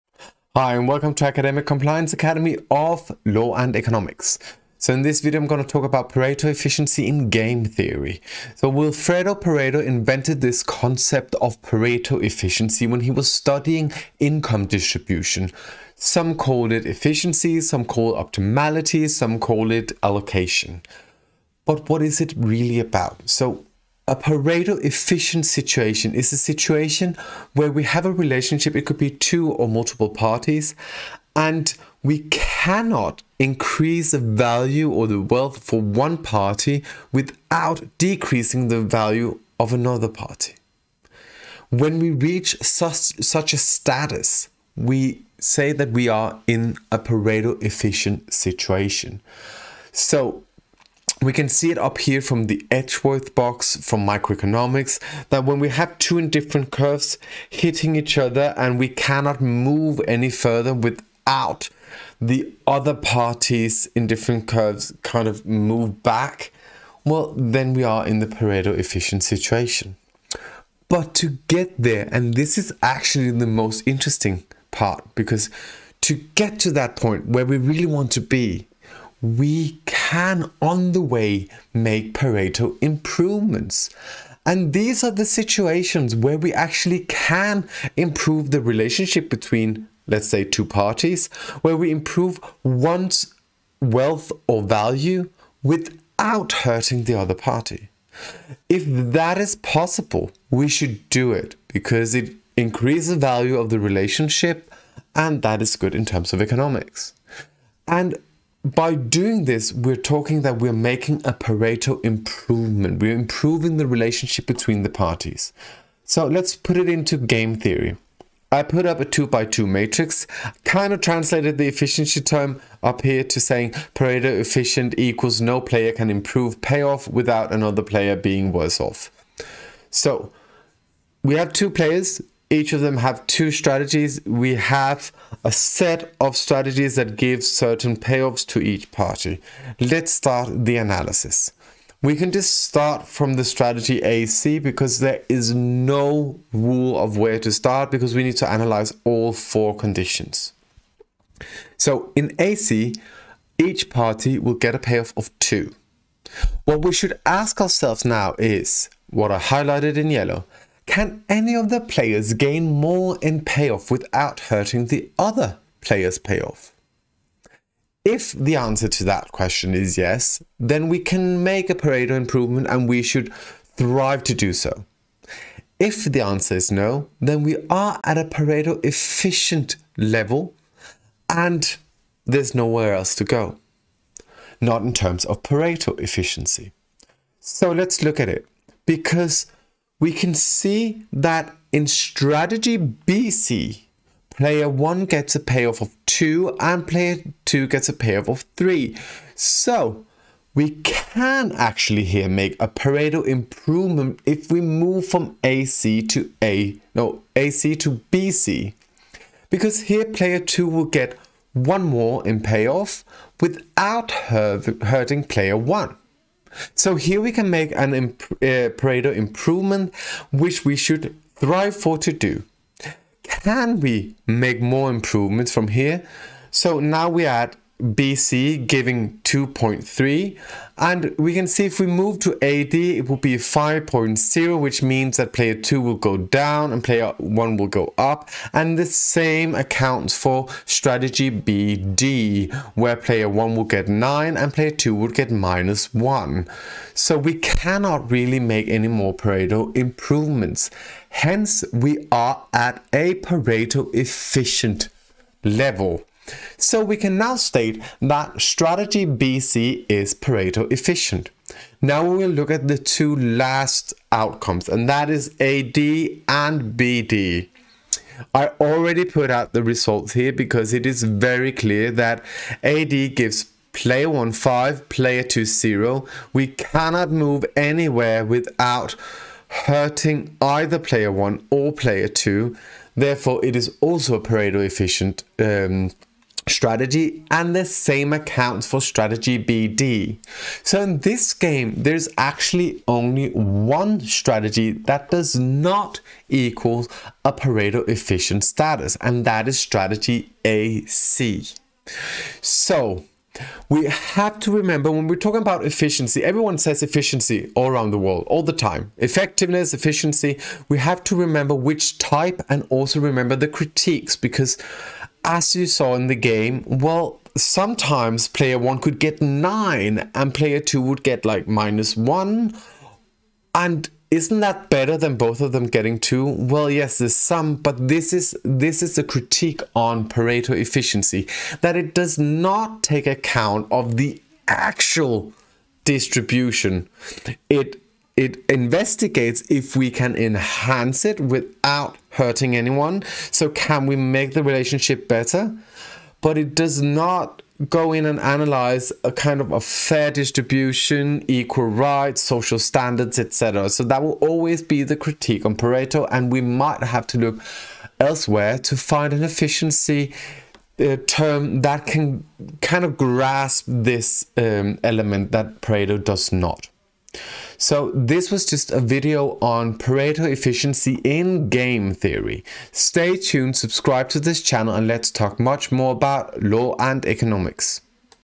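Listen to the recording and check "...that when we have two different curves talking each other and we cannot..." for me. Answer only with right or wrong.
wrong.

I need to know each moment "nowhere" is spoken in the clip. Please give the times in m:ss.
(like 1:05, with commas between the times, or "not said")
3:02.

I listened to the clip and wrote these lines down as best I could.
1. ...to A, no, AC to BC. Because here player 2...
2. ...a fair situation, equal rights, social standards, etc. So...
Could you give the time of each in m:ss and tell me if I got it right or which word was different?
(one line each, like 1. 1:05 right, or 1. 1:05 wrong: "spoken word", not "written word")
1. 3:26 right
2. 5:49 wrong: "distribution", not "situation".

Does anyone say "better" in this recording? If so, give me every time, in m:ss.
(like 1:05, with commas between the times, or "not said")
5:24, 5:45.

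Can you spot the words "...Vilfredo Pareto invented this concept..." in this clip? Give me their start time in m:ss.
0:08.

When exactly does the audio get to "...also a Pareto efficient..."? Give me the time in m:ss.
4:43.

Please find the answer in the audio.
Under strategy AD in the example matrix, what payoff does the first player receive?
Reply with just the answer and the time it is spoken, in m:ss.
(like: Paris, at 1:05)
5, at 4:34.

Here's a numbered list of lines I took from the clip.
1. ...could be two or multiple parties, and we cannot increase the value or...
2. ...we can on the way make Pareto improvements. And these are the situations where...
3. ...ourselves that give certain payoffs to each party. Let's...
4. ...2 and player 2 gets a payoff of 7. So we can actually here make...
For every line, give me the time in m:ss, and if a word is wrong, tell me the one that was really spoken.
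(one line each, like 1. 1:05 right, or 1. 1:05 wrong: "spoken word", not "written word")
1. 0:28 right
2. 1:19 right
3. 2:16 wrong: "strategies", not "ourselves"
4. 3:16 wrong: "3", not "7".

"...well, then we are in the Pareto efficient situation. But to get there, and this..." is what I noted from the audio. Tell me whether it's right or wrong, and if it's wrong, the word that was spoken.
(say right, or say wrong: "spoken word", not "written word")
right.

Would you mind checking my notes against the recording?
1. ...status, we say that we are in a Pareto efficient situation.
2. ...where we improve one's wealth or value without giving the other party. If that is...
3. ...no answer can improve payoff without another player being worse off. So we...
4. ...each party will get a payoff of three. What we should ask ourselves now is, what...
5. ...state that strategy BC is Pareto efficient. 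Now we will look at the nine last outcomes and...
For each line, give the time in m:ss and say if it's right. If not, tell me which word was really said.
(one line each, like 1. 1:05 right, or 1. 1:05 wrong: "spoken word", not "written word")
1. 0:43 right
2. 1:31 wrong: "hurting", not "giving"
3. 2:05 wrong: "player", not "answer"
4. 2:33 wrong: "two", not "three"
5. 4:17 wrong: "two", not "nine".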